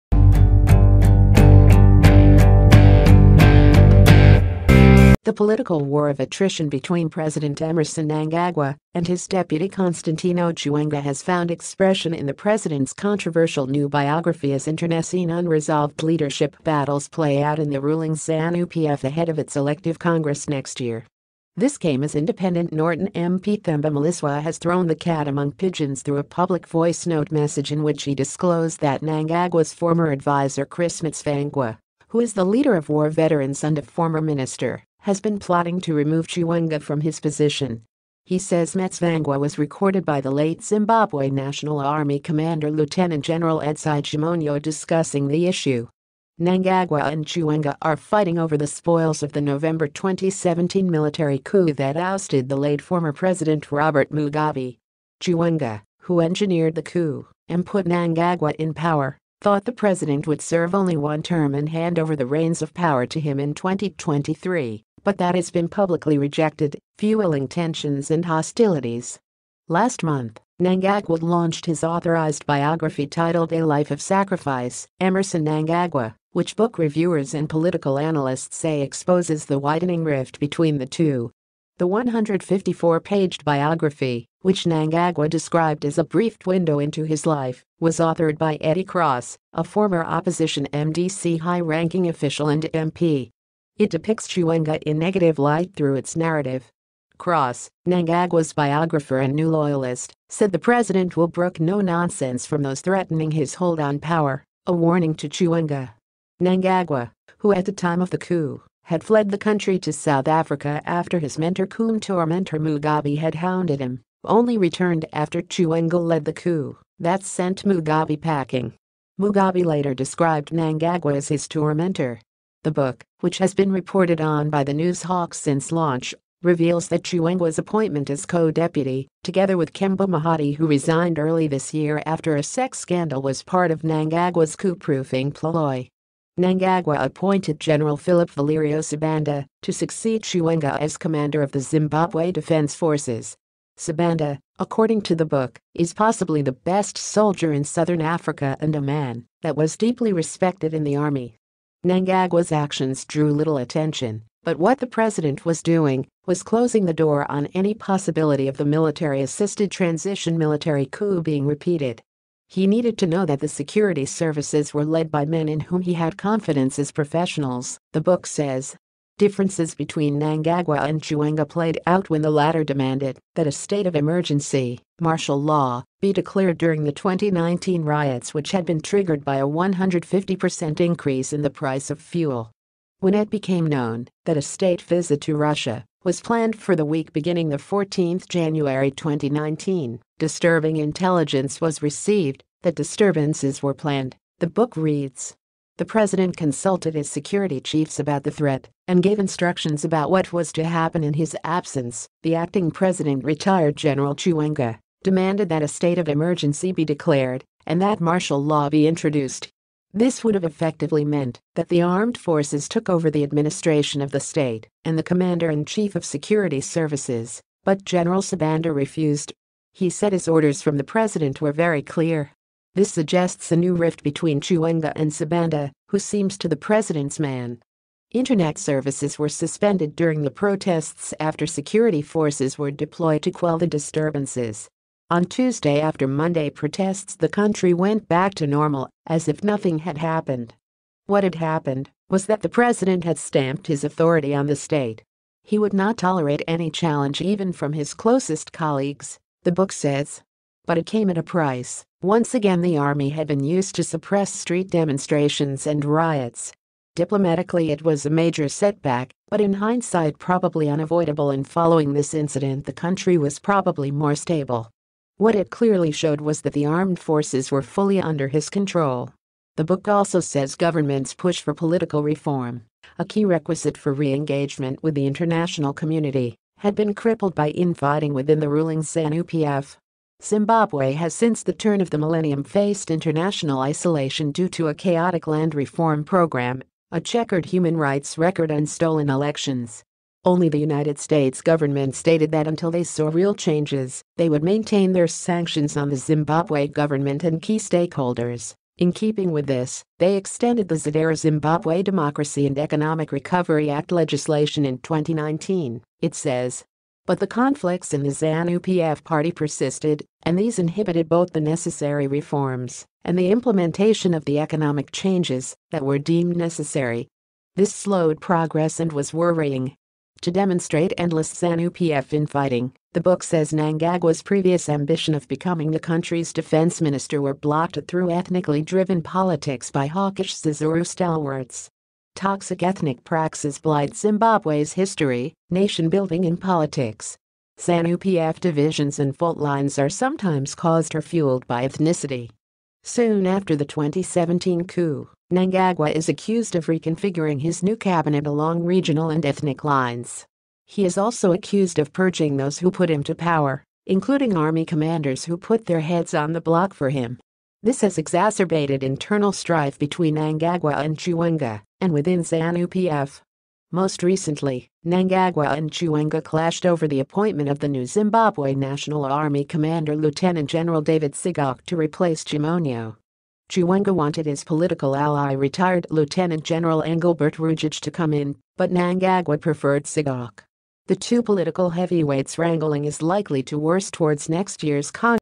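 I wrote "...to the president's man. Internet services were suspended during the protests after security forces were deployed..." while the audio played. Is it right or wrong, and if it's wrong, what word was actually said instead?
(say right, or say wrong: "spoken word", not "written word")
right.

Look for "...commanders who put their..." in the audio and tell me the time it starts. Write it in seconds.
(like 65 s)
354 s.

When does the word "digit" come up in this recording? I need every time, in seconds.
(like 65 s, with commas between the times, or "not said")
not said.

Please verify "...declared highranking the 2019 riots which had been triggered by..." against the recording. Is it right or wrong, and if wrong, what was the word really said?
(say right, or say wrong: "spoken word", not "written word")
wrong: "during", not "highranking".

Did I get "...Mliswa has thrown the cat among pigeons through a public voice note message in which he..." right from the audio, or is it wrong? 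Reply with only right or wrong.
right.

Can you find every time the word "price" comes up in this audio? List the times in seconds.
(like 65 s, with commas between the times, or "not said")
181 s, 251 s.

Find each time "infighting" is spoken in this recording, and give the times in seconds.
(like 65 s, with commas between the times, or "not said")
277 s, 322 s.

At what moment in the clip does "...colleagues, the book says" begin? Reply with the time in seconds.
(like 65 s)
248 s.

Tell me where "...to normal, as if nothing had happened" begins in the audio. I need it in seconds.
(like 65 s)
238 s.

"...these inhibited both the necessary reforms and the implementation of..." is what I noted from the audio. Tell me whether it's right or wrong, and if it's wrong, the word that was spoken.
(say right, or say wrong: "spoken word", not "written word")
right.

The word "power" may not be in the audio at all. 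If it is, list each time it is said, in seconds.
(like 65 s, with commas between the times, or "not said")
58 s, 62 s, 103 s, 353 s.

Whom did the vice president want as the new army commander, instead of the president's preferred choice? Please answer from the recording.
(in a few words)
Engelbert Rugeje.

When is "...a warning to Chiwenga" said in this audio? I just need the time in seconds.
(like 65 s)
104 s.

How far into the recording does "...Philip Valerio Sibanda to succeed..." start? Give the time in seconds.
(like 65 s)
137 s.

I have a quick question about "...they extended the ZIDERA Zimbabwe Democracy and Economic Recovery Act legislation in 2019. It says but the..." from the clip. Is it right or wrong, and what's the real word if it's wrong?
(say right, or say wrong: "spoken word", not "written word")
right.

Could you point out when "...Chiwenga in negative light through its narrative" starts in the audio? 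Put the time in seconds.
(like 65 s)
94 s.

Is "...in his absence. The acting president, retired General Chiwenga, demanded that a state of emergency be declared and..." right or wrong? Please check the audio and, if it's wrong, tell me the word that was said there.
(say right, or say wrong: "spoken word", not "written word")
right.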